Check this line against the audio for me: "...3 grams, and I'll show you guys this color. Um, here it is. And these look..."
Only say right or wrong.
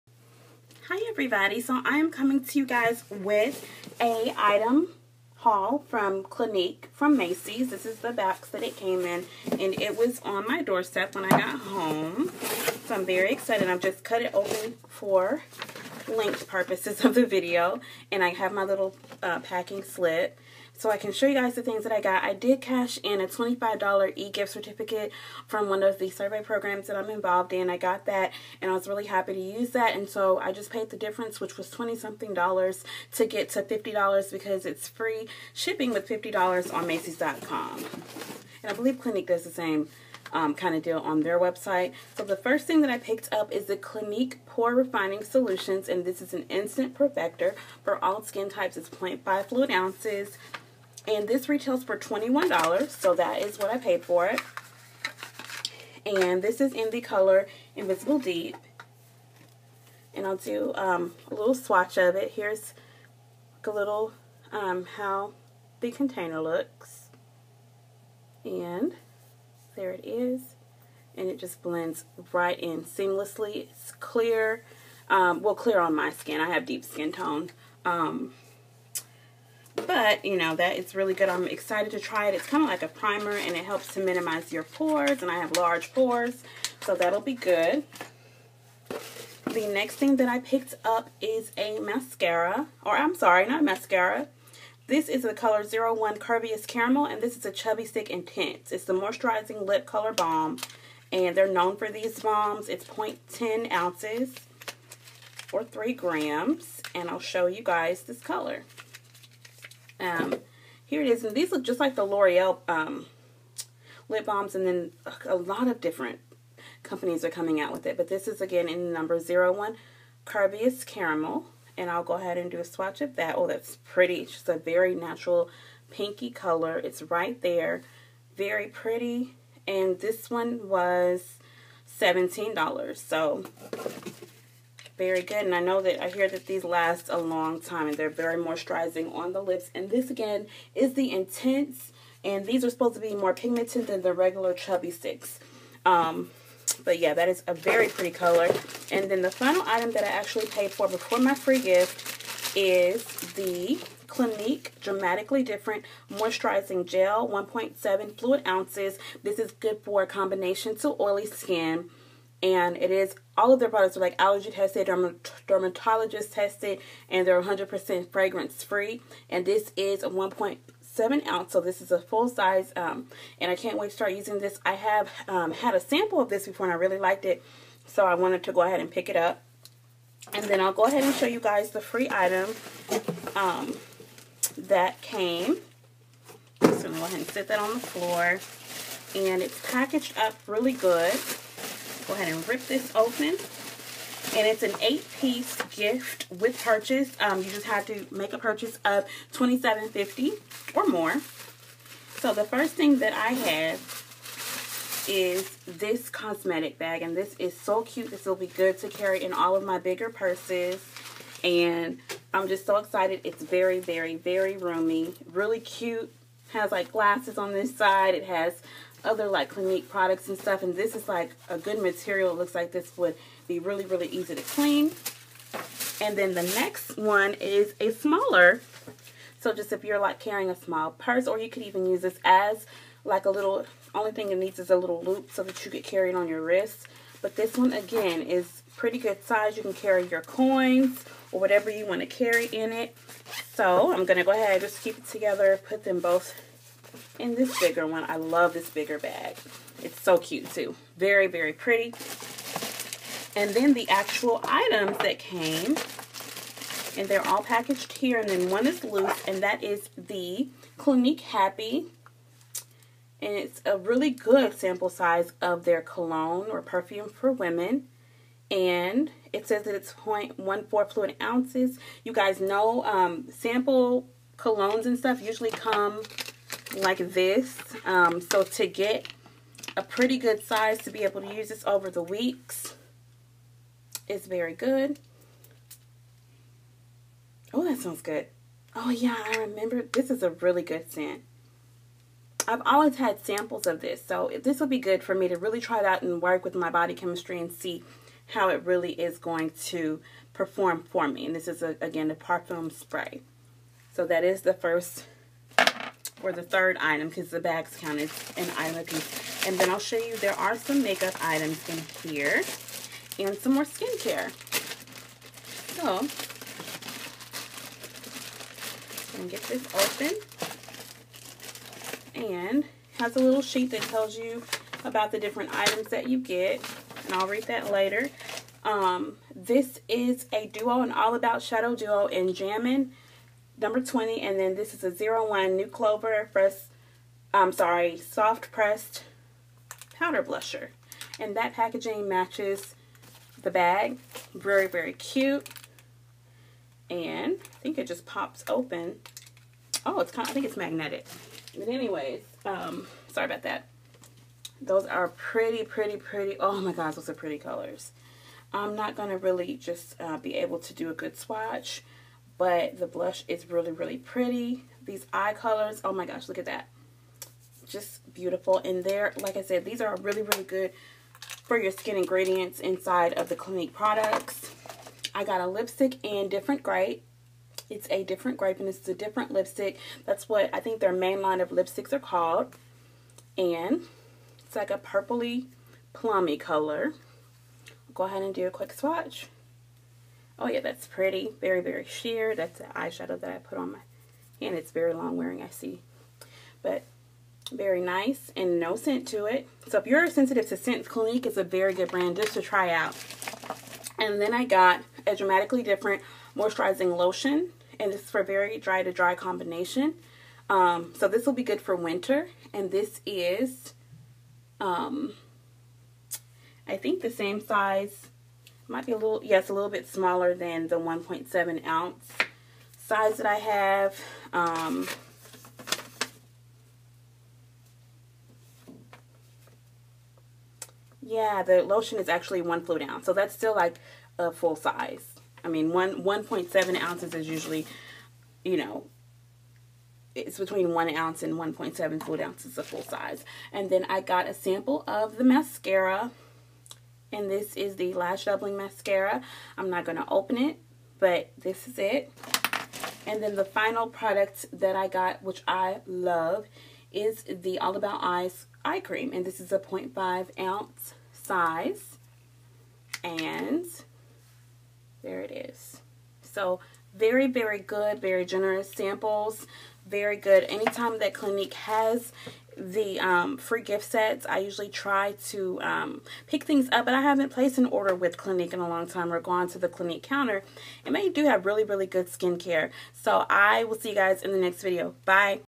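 right.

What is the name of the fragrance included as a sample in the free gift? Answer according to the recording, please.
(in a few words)
Clinique Happy.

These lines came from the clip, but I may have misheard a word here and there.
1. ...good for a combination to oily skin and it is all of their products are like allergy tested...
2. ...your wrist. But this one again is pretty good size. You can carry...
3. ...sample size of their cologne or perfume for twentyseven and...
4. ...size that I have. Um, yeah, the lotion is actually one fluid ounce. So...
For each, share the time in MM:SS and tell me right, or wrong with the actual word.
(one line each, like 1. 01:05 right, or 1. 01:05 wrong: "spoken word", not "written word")
1. 02:39 right
2. 03:56 right
3. 04:24 wrong: "women", not "twentyseven"
4. 07:02 right.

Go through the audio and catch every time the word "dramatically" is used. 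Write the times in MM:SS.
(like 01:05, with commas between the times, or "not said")
02:34, 06:45.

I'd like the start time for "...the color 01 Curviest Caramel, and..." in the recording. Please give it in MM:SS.
01:35.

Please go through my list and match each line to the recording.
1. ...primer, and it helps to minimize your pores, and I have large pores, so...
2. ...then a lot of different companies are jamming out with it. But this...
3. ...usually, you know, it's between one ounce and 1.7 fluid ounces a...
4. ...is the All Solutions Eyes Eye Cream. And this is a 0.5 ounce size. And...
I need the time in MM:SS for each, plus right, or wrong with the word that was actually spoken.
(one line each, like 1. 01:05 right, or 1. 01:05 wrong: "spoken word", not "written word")
1. 01:22 right
2. 01:54 wrong: "coming", not "jamming"
3. 07:17 right
4. 07:36 wrong: "About", not "Solutions".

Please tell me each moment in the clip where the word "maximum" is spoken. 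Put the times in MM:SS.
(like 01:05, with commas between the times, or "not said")
not said.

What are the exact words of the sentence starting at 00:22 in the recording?
I did cash in a $25 e-gift certificate from one of the survey programs that I'm involved in.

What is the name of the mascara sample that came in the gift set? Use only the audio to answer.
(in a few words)
Lash Doubling Mascara.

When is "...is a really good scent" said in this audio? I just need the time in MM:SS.
04:50.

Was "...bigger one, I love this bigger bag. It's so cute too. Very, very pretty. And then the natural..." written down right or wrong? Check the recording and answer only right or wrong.
wrong.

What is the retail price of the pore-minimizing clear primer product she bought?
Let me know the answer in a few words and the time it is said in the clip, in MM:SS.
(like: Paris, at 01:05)
$21, at 00:51.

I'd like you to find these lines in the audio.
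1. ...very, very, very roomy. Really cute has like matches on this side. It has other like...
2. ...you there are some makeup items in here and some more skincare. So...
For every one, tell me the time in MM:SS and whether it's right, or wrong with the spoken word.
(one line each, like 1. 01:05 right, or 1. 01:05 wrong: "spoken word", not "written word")
1. 03:33 wrong: "glasses", not "matches"
2. 05:09 right.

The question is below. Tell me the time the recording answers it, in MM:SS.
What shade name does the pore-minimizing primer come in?
00:57.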